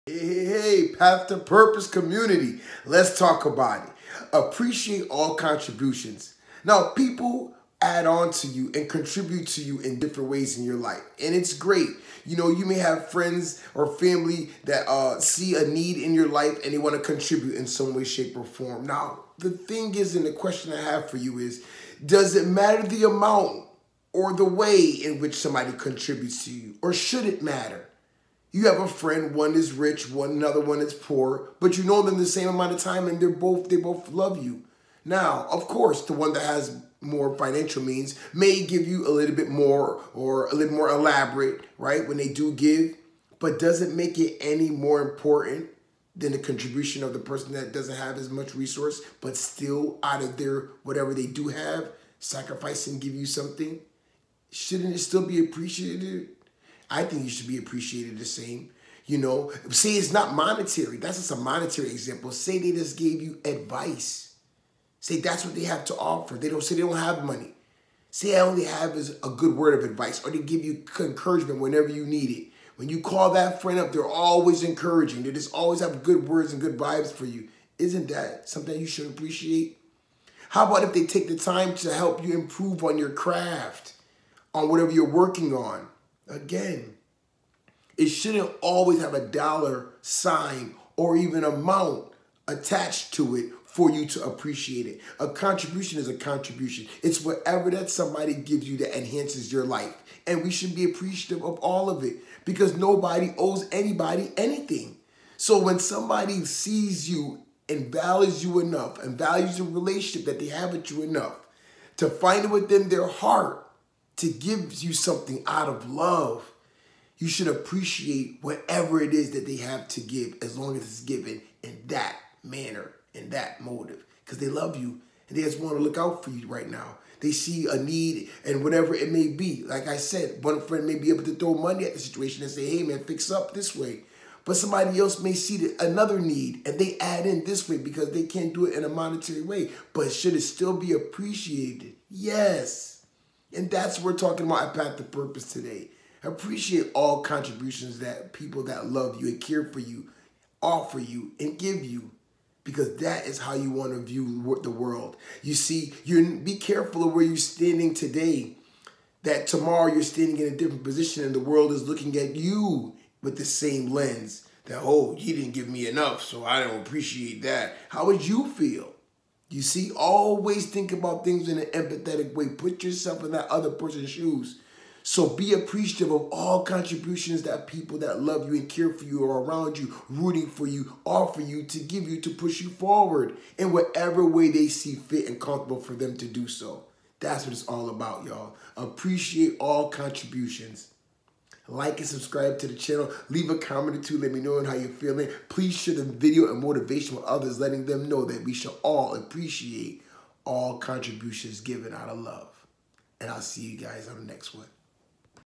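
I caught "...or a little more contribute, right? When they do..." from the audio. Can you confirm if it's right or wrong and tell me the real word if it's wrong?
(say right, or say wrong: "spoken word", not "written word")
wrong: "elaborate", not "contribute".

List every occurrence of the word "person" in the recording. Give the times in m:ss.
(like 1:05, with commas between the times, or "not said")
0:47, 2:53.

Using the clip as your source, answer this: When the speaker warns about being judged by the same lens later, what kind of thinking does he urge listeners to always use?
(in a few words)
empathetic.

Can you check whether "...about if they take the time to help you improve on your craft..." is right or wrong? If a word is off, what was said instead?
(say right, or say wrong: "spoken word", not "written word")
right.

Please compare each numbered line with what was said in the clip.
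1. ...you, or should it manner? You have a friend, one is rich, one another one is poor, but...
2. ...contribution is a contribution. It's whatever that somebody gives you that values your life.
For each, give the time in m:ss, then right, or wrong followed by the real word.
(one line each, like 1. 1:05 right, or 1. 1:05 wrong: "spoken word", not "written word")
1. 0:26 wrong: "matter", not "manner"
2. 1:35 wrong: "enhances", not "values".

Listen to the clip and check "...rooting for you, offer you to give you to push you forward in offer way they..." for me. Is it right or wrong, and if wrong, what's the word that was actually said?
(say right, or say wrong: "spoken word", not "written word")
wrong: "whatever", not "offer".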